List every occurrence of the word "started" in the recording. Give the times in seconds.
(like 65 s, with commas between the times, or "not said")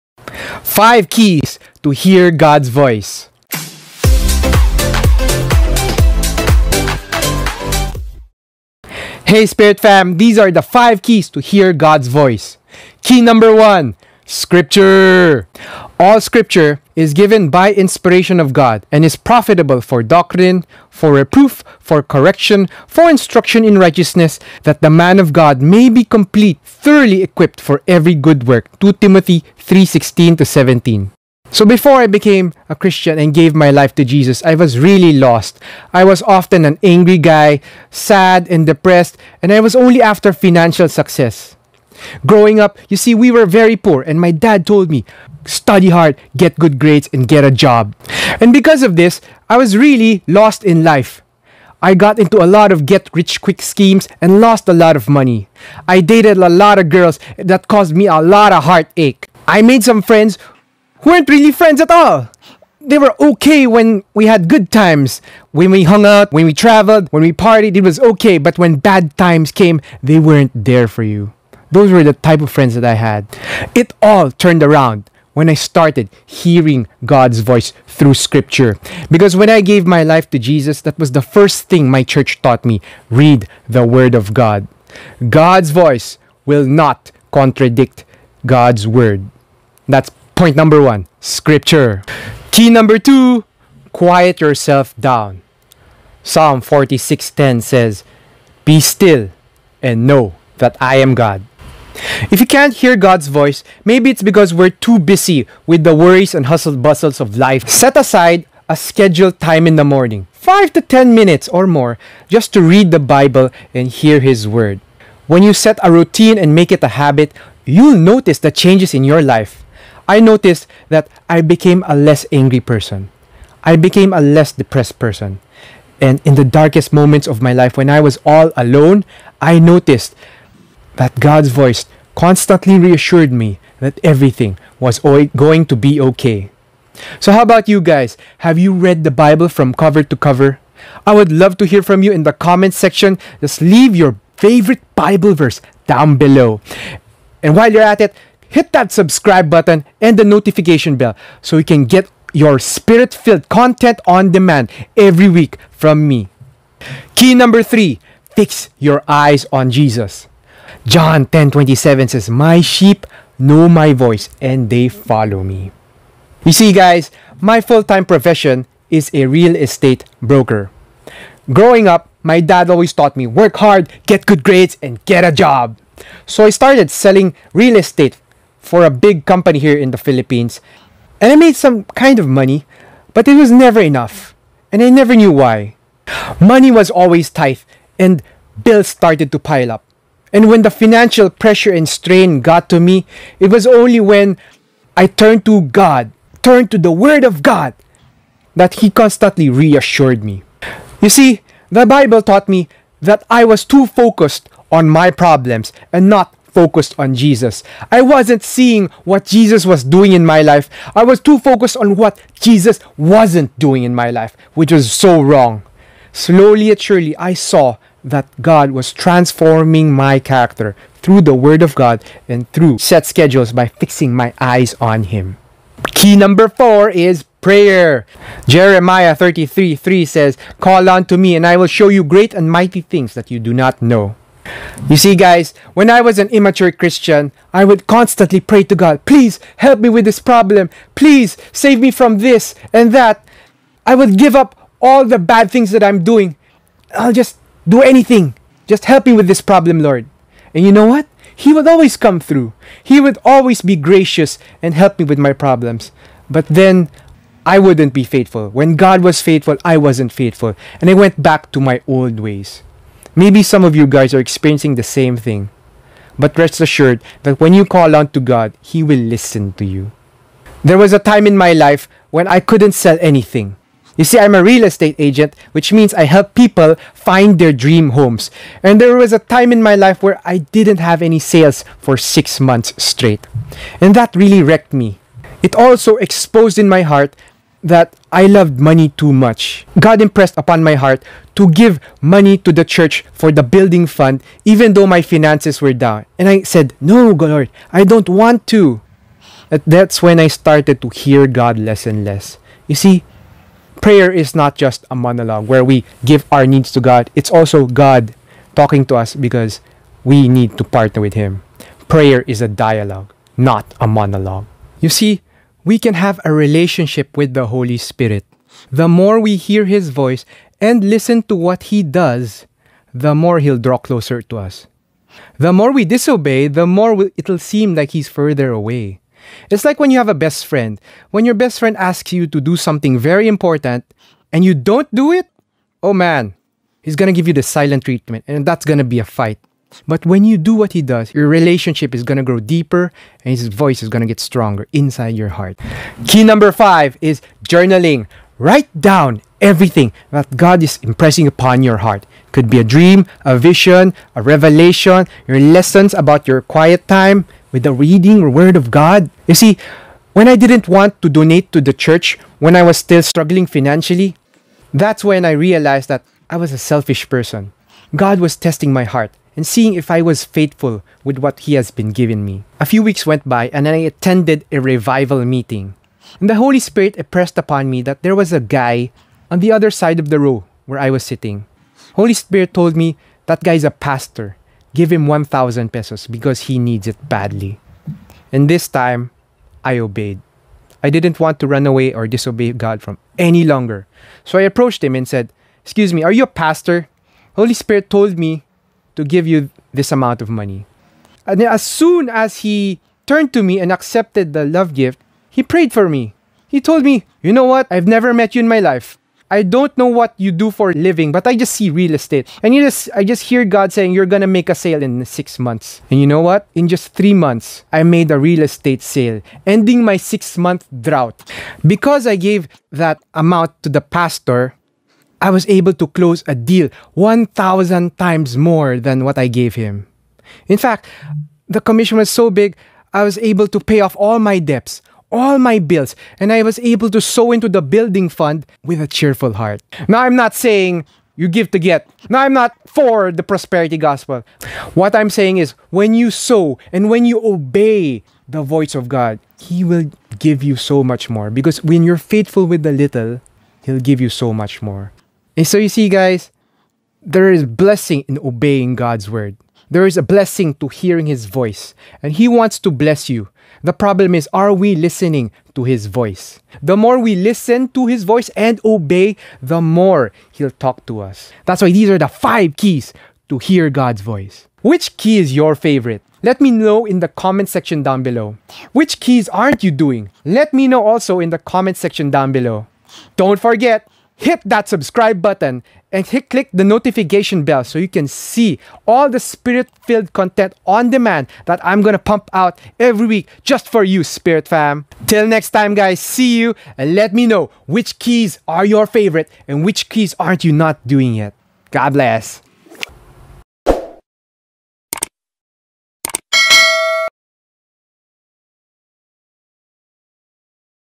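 75 s, 176 s, 188 s, 300 s.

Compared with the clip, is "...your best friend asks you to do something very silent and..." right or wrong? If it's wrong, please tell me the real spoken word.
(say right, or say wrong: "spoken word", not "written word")
wrong: "important", not "silent".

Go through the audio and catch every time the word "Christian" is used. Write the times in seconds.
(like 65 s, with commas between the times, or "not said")
32 s, 236 s.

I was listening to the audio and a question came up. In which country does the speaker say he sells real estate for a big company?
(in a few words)
Philippines.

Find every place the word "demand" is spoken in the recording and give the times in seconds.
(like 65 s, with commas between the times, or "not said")
154 s, 490 s.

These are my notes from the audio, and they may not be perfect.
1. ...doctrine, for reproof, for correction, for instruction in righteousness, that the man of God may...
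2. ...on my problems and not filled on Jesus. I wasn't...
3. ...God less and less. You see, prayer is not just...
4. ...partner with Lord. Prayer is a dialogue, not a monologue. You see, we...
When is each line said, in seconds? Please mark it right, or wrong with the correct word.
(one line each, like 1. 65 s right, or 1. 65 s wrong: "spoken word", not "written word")
1. 20 s right
2. 204 s wrong: "focused", not "filled"
3. 301 s right
4. 310 s wrong: "Him", not "Lord".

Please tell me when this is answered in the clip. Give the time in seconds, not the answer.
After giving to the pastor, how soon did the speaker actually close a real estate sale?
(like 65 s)
416 s.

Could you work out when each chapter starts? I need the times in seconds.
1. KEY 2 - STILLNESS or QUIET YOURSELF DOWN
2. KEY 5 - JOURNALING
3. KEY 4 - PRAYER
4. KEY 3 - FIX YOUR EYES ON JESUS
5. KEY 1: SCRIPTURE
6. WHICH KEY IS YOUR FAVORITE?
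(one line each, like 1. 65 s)
1. 92 s
2. 345 s
3. 225 s
4. 156 s
5. 13 s
6. 470 s.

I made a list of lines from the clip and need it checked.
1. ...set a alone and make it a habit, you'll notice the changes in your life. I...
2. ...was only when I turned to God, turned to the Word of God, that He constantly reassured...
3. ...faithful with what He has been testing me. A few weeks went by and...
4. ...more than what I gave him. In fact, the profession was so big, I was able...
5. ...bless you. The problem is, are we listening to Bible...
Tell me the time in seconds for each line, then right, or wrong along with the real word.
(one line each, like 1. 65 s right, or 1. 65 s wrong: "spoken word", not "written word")
1. 115 s wrong: "routine", not "alone"
2. 193 s right
3. 370 s wrong: "giving", not "testing"
4. 428 s wrong: "commission", not "profession"
5. 462 s wrong: "His", not "Bible".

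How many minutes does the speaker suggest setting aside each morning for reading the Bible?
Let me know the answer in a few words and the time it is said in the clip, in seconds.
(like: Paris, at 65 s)
5 to 10 minutes, at 110 s.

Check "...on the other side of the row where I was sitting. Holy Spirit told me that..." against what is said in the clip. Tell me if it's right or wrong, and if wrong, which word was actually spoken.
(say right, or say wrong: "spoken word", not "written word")
right.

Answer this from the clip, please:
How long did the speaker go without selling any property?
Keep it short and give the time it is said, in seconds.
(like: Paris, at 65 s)
6 months, at 281 s.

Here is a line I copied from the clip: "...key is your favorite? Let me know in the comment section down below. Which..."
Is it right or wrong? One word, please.
right.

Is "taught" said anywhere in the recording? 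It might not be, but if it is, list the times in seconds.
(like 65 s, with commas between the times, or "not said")
82 s, 172 s, 202 s.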